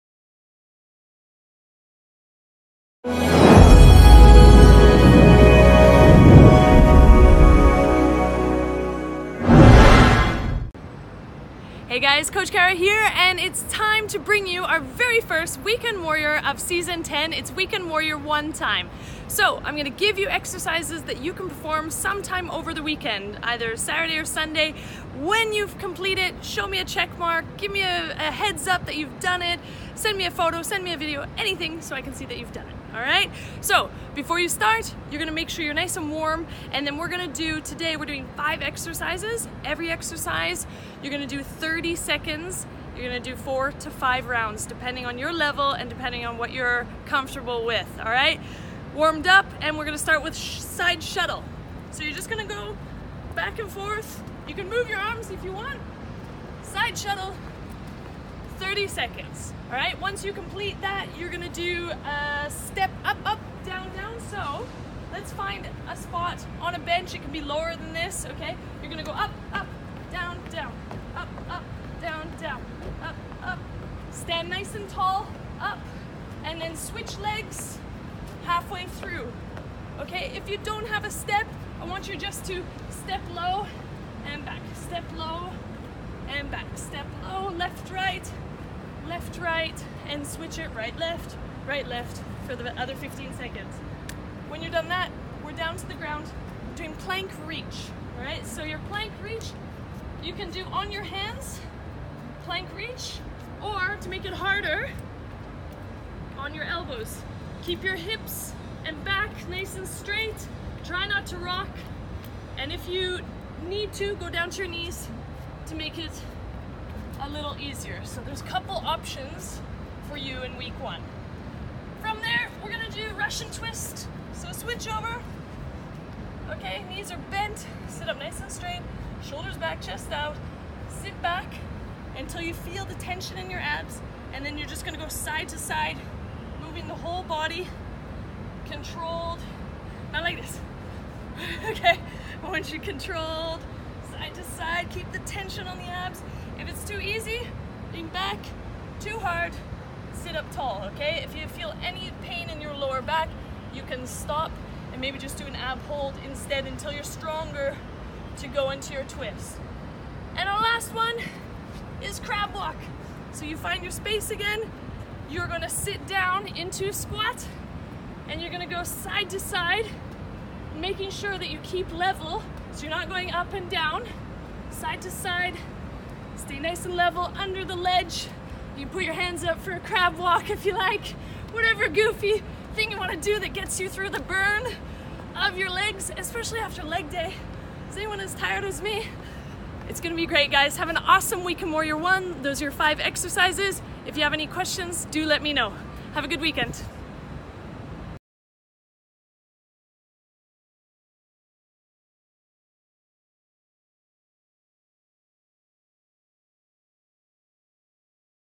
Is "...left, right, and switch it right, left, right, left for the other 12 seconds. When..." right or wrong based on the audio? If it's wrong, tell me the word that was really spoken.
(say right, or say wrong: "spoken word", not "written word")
wrong: "15", not "12".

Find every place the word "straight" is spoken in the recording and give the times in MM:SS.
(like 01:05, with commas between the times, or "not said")
01:49, 02:08.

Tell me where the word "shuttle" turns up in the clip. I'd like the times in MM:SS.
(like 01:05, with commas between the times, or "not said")
00:51, 00:56.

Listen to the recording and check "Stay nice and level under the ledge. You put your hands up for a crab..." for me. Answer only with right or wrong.
right.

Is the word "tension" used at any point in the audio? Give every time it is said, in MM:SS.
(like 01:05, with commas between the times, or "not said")
02:12, 02:25.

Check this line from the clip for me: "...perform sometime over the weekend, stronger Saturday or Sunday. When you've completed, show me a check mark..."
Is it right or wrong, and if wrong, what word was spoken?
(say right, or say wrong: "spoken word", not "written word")
wrong: "either", not "stronger".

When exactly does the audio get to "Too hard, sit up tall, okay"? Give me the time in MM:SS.
02:28.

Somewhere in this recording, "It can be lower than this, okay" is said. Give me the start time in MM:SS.
01:07.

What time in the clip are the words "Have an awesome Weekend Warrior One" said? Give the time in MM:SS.
03:10.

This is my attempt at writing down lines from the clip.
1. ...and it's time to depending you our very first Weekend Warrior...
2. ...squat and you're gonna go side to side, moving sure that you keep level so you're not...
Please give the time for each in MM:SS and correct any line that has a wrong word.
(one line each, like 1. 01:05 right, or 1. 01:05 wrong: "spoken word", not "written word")
1. 00:13 wrong: "bring", not "depending"
2. 02:46 wrong: "making", not "moving".